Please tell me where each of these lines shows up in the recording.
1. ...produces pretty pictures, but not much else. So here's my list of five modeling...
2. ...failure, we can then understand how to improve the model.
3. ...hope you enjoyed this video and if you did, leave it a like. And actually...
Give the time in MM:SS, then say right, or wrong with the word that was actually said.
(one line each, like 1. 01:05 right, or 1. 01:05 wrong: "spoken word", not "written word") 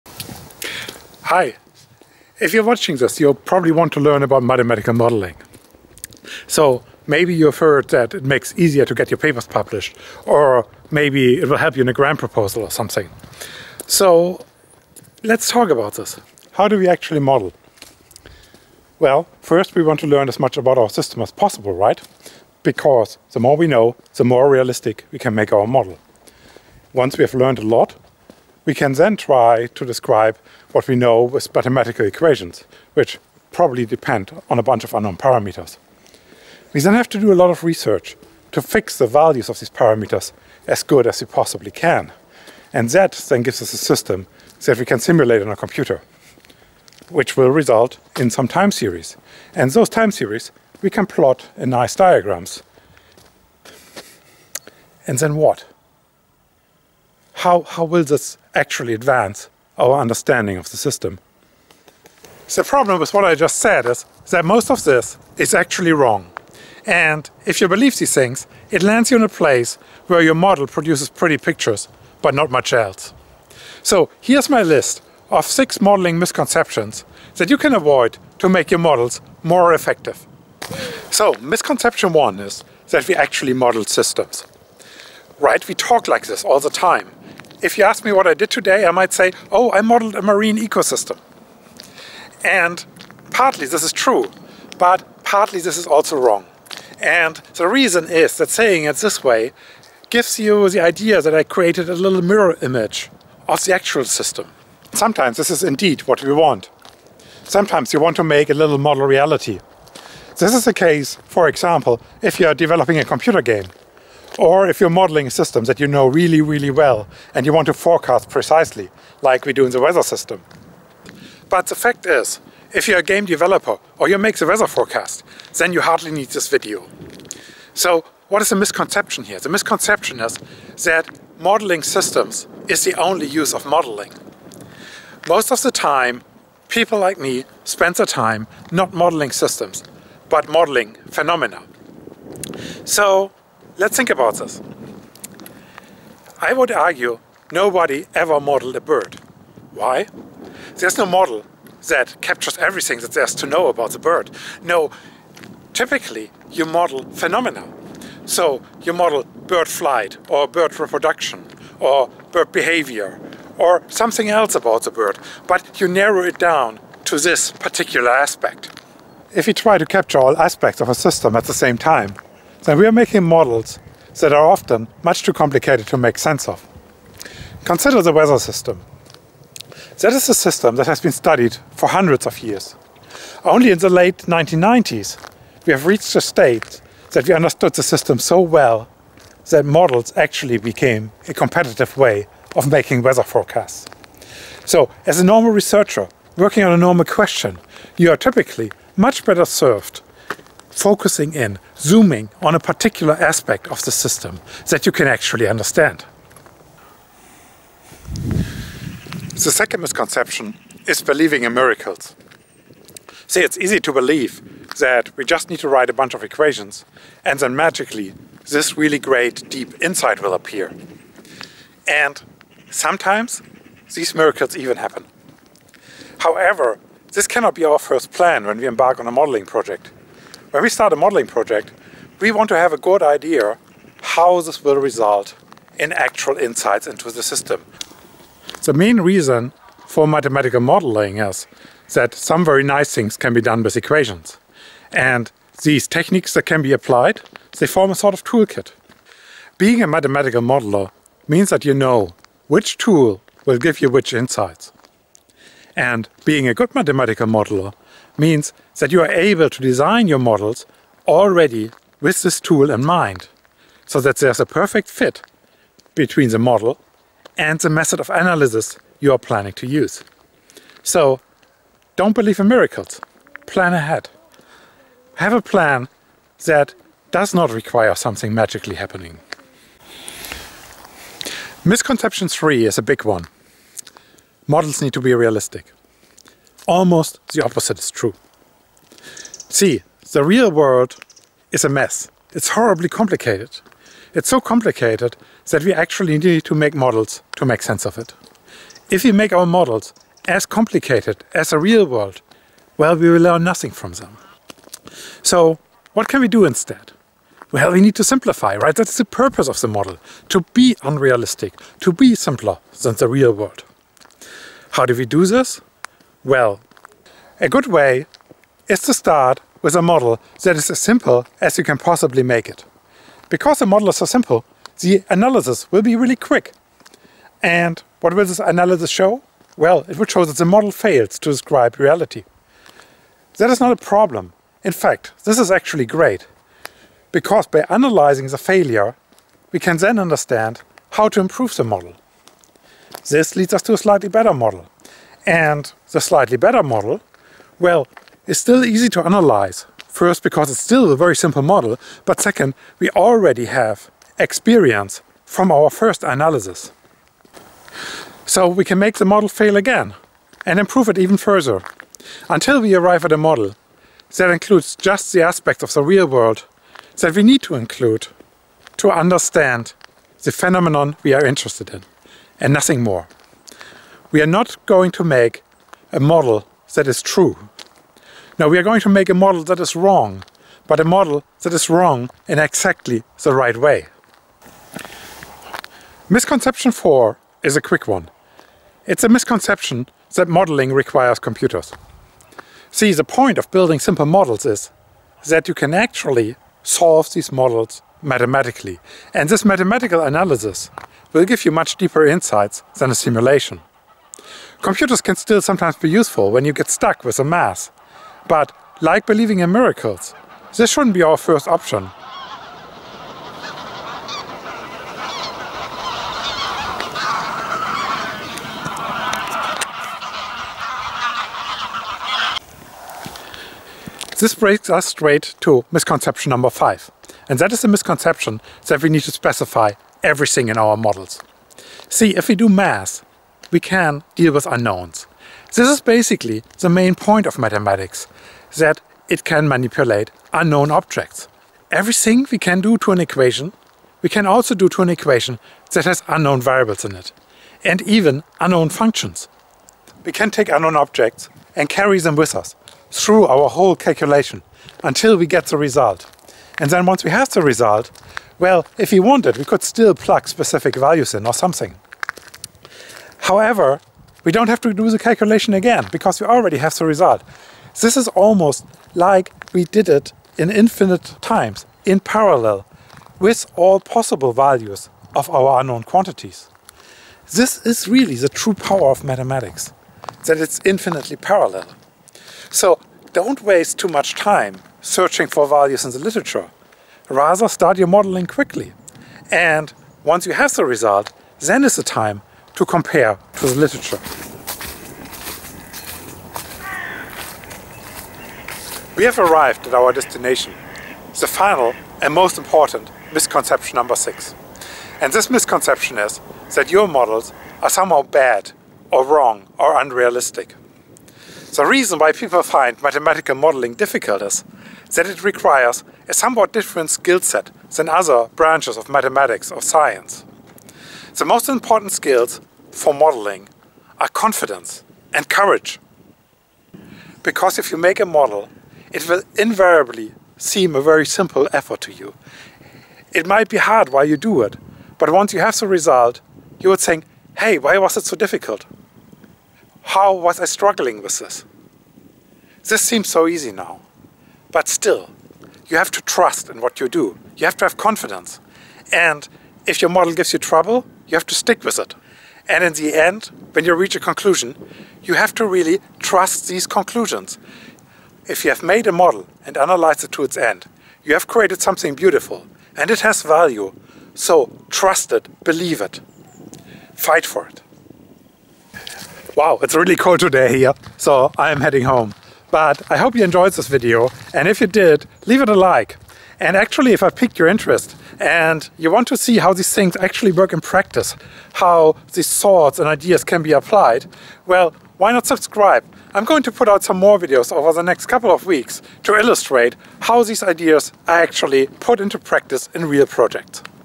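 1. 01:10 wrong: "six", not "five"
2. 05:38 right
3. 09:32 right.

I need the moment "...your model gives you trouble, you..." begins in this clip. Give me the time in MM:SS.
09:09.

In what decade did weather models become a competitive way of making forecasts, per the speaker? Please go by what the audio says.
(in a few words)
Late 1990s.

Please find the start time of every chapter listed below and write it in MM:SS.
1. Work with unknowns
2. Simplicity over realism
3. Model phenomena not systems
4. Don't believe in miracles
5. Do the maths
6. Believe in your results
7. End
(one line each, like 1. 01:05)
1. 07:03
2. 04:40
3. 01:20
4. 03:26
5. 06:24
6. 08:13
7. 09:29.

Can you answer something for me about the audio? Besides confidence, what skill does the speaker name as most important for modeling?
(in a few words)
Courage.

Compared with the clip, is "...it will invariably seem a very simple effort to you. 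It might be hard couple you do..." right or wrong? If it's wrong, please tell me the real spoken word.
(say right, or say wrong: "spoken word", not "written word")
wrong: "while", not "couple".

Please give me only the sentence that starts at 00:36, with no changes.
We then have to do a lot of research to fix the values of these parameters as good as we possibly can.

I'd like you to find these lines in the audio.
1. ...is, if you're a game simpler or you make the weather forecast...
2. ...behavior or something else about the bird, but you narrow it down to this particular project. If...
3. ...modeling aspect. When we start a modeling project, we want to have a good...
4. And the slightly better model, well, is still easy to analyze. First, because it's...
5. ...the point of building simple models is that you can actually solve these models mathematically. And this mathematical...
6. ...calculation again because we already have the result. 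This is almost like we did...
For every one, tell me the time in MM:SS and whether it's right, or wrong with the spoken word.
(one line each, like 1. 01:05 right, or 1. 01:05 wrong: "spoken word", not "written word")
1. 02:02 wrong: "developer", not "simpler"
2. 02:42 wrong: "aspect", not "project"
3. 03:49 wrong: "project", not "aspect"
4. 05:45 right
5. 06:32 right
6. 07:44 right.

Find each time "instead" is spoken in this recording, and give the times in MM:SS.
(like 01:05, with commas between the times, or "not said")
05:06.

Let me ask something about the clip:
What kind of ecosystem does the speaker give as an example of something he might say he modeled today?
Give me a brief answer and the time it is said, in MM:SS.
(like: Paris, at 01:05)
Marine ecosystem, at 01:30.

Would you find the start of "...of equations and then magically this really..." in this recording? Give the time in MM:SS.
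03:36.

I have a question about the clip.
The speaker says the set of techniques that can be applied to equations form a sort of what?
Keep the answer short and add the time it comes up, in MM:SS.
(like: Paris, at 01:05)
Toolkit, at 04:08.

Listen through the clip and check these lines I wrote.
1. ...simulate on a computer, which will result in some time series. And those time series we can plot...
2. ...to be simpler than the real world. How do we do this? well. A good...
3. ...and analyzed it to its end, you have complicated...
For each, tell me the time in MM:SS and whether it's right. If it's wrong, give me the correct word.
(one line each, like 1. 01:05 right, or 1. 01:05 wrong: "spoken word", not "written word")
1. 00:44 right
2. 05:11 right
3. 09:19 wrong: "created", not "complicated".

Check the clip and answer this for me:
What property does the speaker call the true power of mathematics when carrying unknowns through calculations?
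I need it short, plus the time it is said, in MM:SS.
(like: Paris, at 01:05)
Infinitely parallel, at 08:00.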